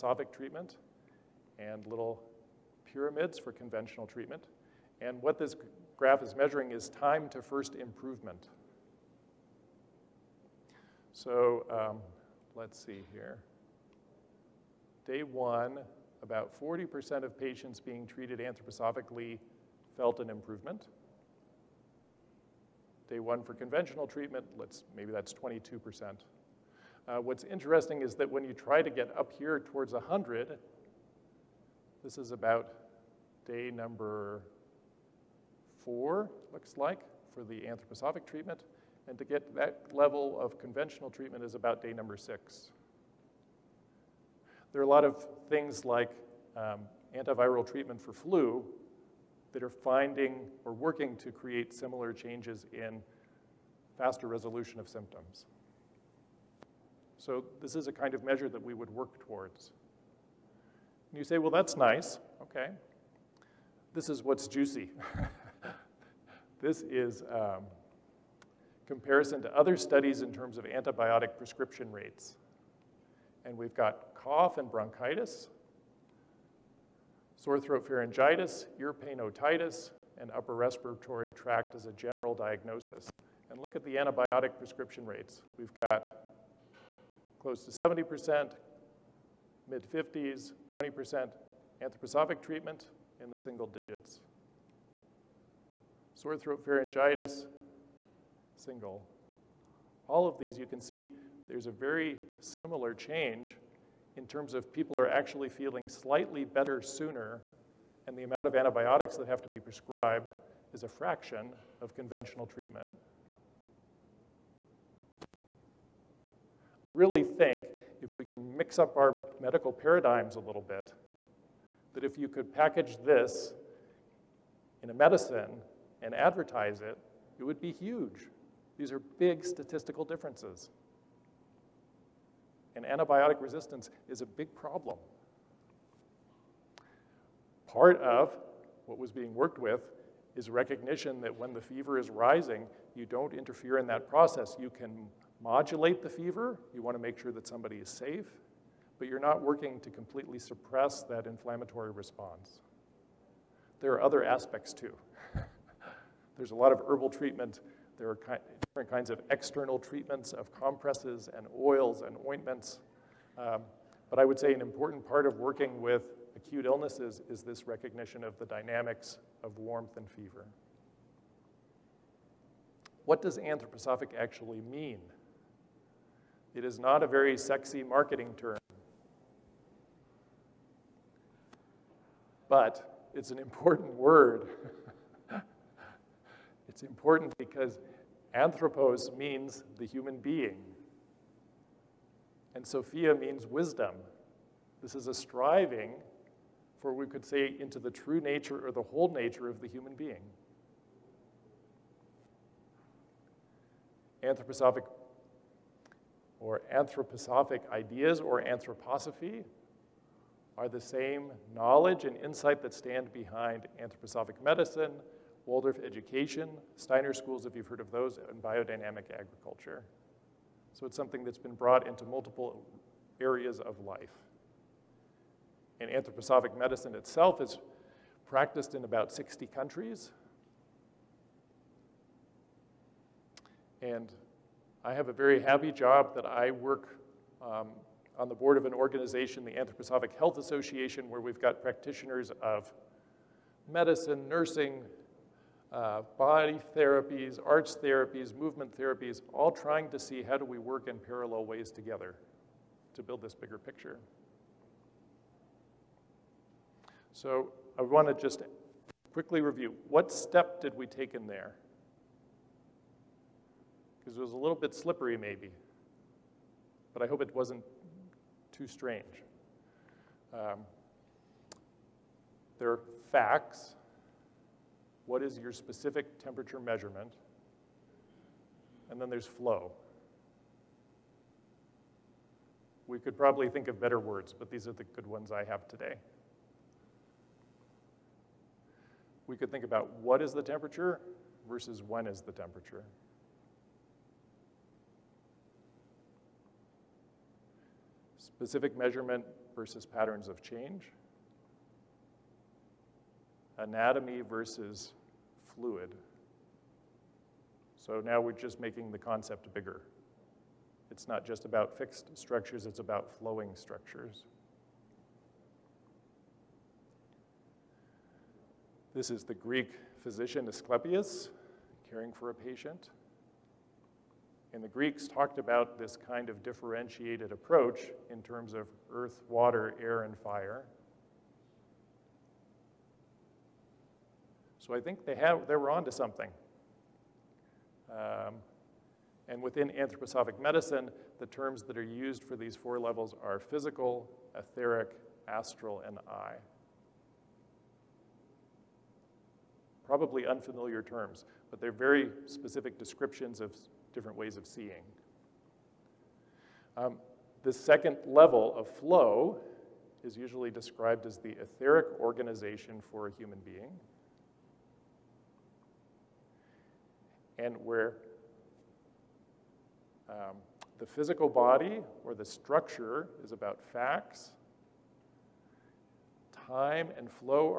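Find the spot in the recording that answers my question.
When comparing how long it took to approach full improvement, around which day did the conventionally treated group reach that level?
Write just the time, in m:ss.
0:41.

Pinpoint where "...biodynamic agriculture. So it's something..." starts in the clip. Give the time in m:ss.
3:38.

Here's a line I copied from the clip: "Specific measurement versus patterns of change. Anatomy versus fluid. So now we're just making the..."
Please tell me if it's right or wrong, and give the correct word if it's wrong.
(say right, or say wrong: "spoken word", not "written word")
right.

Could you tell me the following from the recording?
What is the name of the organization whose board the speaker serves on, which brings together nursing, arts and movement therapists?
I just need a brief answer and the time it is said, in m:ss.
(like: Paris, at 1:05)
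Anthroposophic Health Association, at 3:59.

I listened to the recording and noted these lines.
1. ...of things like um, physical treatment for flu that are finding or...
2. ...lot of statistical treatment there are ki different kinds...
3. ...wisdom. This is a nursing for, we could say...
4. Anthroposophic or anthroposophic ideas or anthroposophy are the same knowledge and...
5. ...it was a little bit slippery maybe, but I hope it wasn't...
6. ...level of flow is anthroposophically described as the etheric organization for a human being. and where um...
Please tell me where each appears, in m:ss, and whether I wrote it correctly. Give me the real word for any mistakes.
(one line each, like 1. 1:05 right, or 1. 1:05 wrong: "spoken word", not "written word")
1. 0:45 wrong: "antiviral", not "physical"
2. 2:36 wrong: "herbal", not "statistical"
3. 3:13 wrong: "striving", not "nursing"
4. 3:24 right
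5. 4:24 right
6. 5:58 wrong: "usually", not "anthroposophically".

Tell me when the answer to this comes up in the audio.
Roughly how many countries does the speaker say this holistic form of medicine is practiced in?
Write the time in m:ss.
3:48.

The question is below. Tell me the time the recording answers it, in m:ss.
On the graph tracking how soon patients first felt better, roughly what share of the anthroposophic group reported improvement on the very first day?
0:16.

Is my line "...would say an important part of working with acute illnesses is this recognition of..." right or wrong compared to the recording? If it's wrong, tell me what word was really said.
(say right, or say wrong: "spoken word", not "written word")
right.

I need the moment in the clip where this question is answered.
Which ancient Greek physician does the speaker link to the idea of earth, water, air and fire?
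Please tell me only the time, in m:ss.
5:20.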